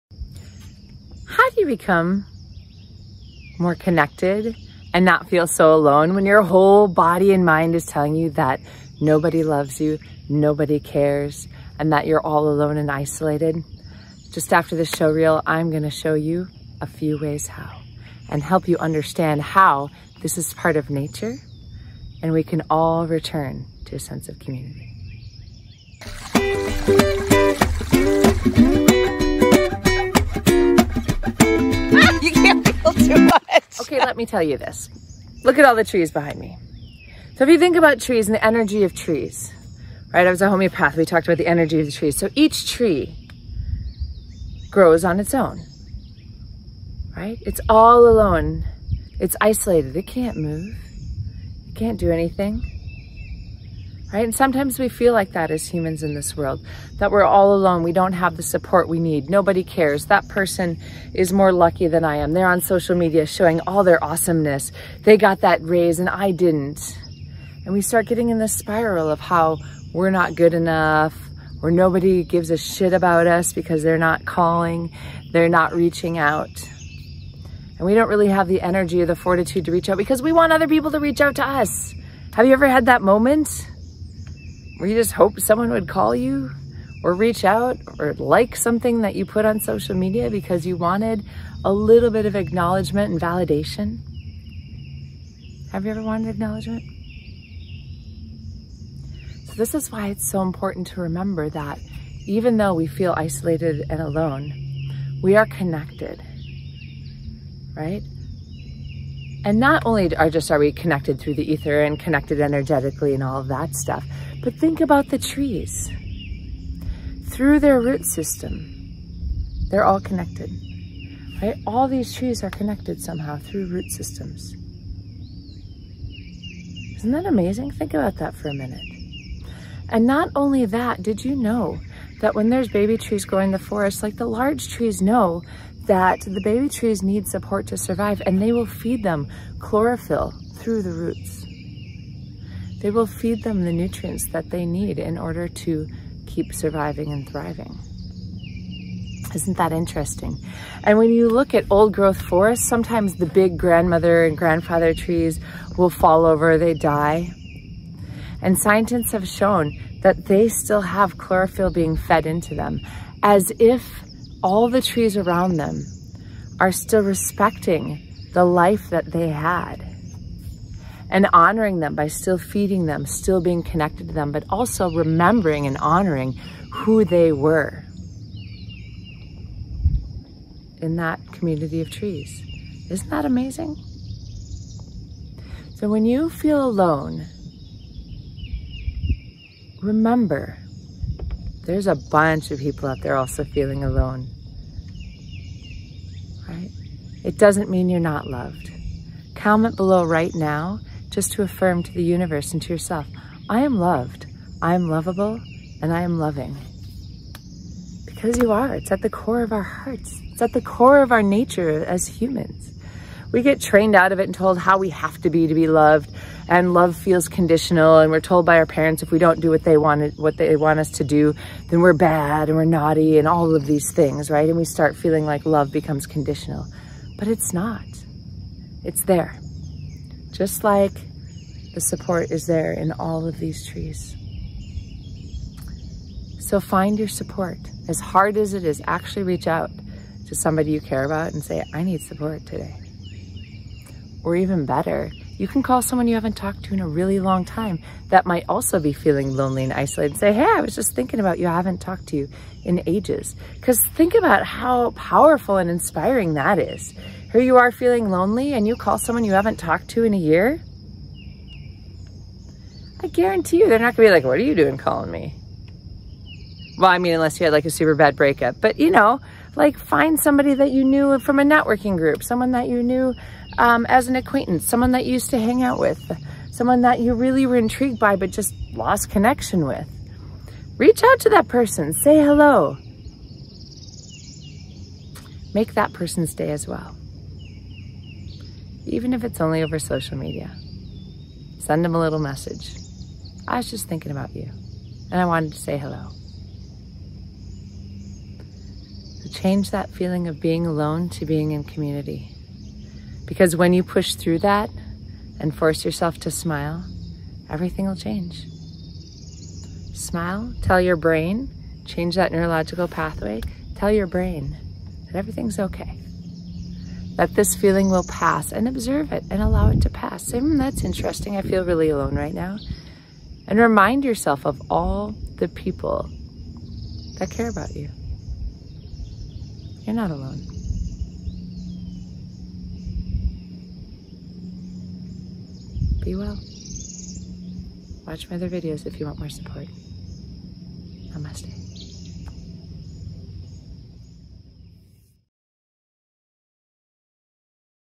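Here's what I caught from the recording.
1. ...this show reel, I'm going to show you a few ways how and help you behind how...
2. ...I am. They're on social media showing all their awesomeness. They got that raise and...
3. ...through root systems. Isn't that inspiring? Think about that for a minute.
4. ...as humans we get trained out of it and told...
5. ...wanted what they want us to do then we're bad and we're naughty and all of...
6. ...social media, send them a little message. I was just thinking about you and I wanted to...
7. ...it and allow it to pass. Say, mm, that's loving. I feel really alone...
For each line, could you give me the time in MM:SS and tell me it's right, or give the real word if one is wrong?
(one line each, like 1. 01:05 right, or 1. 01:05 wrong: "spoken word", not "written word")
1. 00:14 wrong: "understand", not "behind"
2. 01:02 right
3. 02:03 wrong: "amazing", not "inspiring"
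4. 03:31 right
5. 03:39 right
6. 04:49 right
7. 05:19 wrong: "interesting", not "loving".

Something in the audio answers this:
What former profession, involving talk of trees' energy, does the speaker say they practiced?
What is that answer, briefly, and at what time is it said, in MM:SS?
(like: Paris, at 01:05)
homeopath, at 00:40.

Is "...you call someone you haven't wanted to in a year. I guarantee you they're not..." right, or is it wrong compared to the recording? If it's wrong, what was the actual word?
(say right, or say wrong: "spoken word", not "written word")
wrong: "talked", not "wanted".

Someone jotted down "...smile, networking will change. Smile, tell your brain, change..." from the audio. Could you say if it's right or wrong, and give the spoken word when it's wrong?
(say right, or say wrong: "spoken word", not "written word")
wrong: "everything", not "networking".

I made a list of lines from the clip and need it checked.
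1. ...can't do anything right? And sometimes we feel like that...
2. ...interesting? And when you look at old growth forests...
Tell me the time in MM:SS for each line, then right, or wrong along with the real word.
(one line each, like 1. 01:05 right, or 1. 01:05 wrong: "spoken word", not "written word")
1. 00:51 right
2. 02:29 right.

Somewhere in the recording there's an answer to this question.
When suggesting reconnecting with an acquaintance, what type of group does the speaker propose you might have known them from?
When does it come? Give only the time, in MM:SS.
04:31.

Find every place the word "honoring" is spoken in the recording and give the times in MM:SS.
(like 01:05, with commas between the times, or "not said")
02:51, 02:55.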